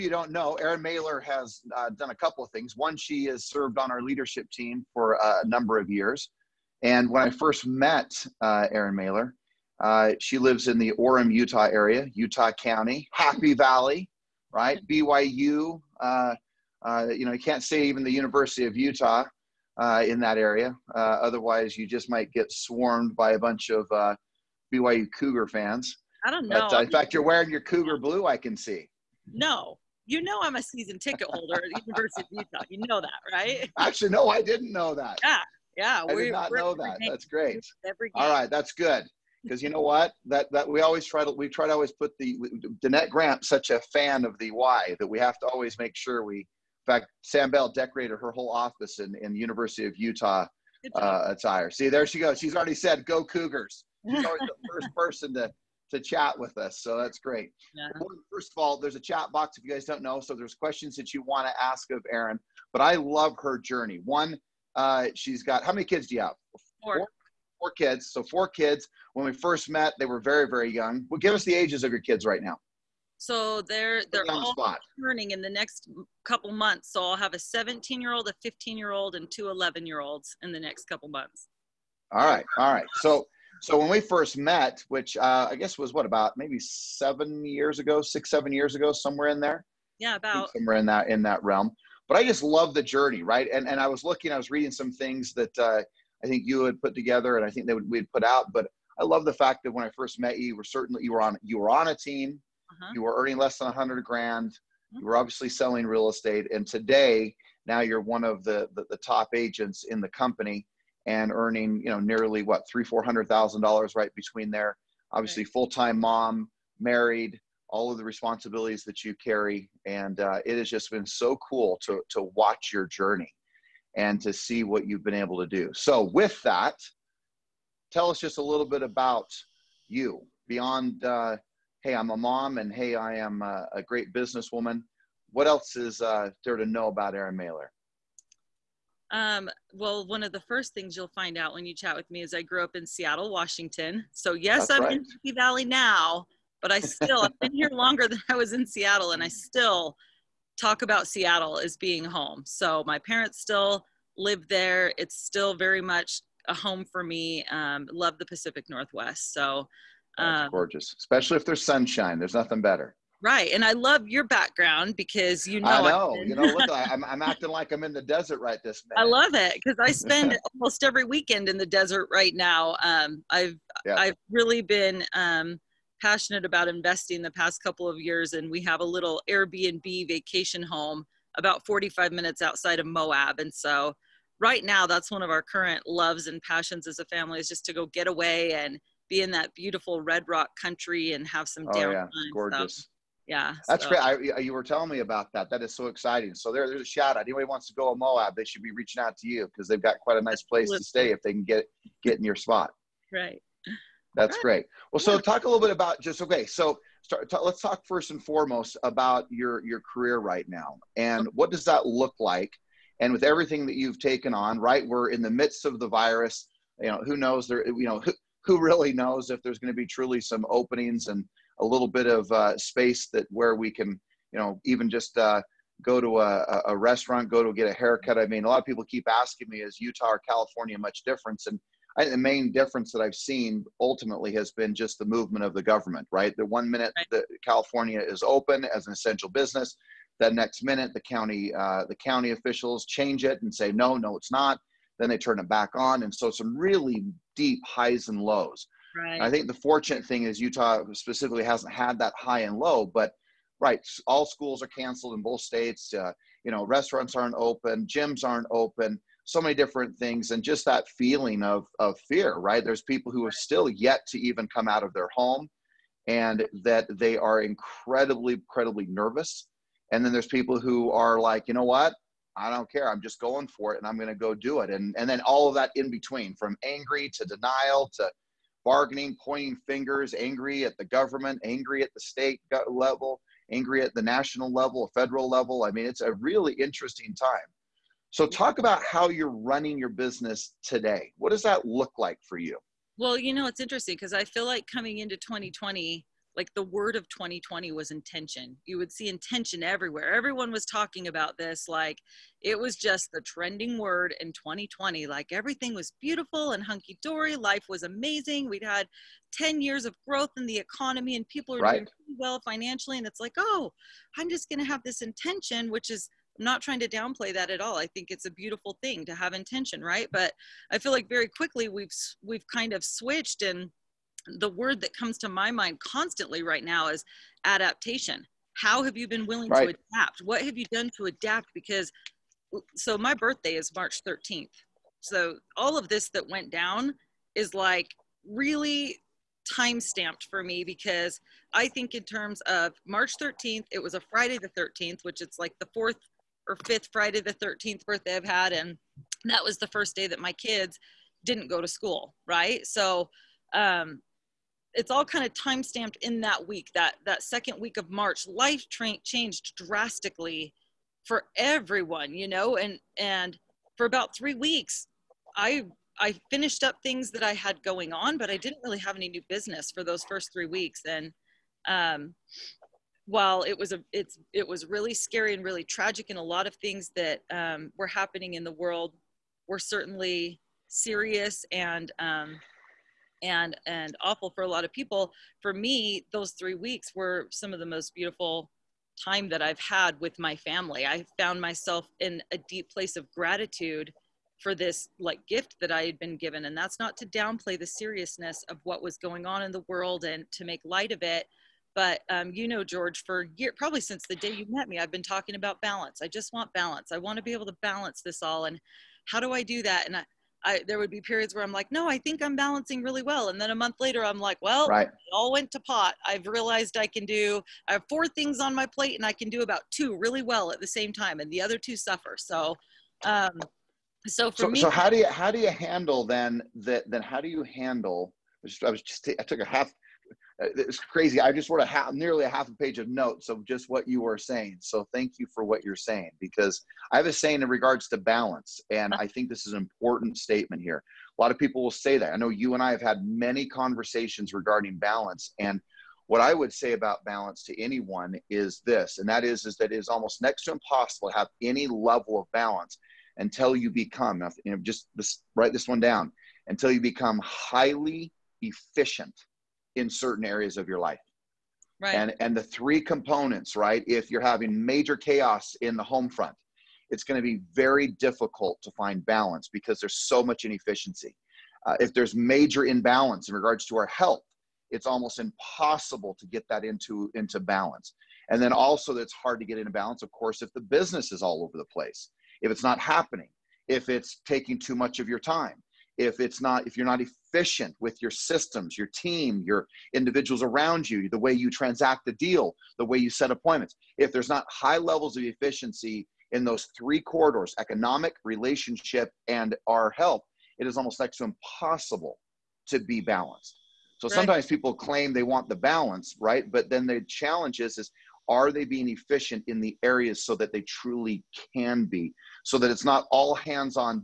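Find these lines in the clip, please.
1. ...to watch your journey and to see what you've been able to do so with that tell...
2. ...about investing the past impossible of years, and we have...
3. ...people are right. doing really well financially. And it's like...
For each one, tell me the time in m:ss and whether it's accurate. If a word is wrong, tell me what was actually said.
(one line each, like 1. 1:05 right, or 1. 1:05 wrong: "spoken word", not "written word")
1. 2:02 right
2. 2:56 wrong: "couple", not "impossible"
3. 5:11 right.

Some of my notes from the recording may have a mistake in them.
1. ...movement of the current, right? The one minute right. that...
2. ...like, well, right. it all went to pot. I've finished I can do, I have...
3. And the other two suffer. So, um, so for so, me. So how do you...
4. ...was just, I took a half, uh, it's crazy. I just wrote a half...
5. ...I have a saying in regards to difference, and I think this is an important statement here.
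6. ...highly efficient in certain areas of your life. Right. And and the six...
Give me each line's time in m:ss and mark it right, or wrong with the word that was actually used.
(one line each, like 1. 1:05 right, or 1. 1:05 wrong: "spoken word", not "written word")
1. 3:55 wrong: "government", not "current"
2. 6:54 wrong: "realized", not "finished"
3. 7:01 right
4. 7:08 right
5. 7:16 wrong: "balance", not "difference"
6. 7:37 wrong: "three", not "six".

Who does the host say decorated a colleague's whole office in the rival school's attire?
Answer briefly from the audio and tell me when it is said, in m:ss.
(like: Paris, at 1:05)
Sam Bell, at 0:47.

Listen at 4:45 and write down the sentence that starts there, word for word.
I mean, it's a really interesting time.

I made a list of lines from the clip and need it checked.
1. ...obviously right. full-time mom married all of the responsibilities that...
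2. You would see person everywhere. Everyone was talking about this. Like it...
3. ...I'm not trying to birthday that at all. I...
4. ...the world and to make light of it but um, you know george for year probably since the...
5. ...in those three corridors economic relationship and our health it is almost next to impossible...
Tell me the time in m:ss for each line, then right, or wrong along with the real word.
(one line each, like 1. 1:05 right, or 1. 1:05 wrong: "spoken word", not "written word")
1. 1:55 right
2. 4:58 wrong: "intention", not "person"
3. 5:16 wrong: "downplay", not "birthday"
4. 6:39 right
5. 8:16 right.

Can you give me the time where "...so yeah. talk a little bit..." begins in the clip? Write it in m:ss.
3:25.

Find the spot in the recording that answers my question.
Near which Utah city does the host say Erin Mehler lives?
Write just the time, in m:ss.
0:10.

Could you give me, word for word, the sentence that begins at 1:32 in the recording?
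But I just love the journey, right?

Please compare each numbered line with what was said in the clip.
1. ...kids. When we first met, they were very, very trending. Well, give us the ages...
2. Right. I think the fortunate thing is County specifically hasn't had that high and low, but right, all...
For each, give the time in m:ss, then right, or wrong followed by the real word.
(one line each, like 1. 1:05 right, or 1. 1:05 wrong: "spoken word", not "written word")
1. 1:08 wrong: "young", not "trending"
2. 4:08 wrong: "Utah", not "County".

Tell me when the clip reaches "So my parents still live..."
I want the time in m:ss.
2:32.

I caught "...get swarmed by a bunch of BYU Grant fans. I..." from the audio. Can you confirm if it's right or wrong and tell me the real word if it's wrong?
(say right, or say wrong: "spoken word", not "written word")
wrong: "Cougar", not "Grant".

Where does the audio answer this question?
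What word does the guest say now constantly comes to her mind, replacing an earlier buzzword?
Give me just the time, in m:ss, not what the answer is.
5:27.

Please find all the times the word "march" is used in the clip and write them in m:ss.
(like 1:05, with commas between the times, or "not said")
5:33, 5:42, 5:57.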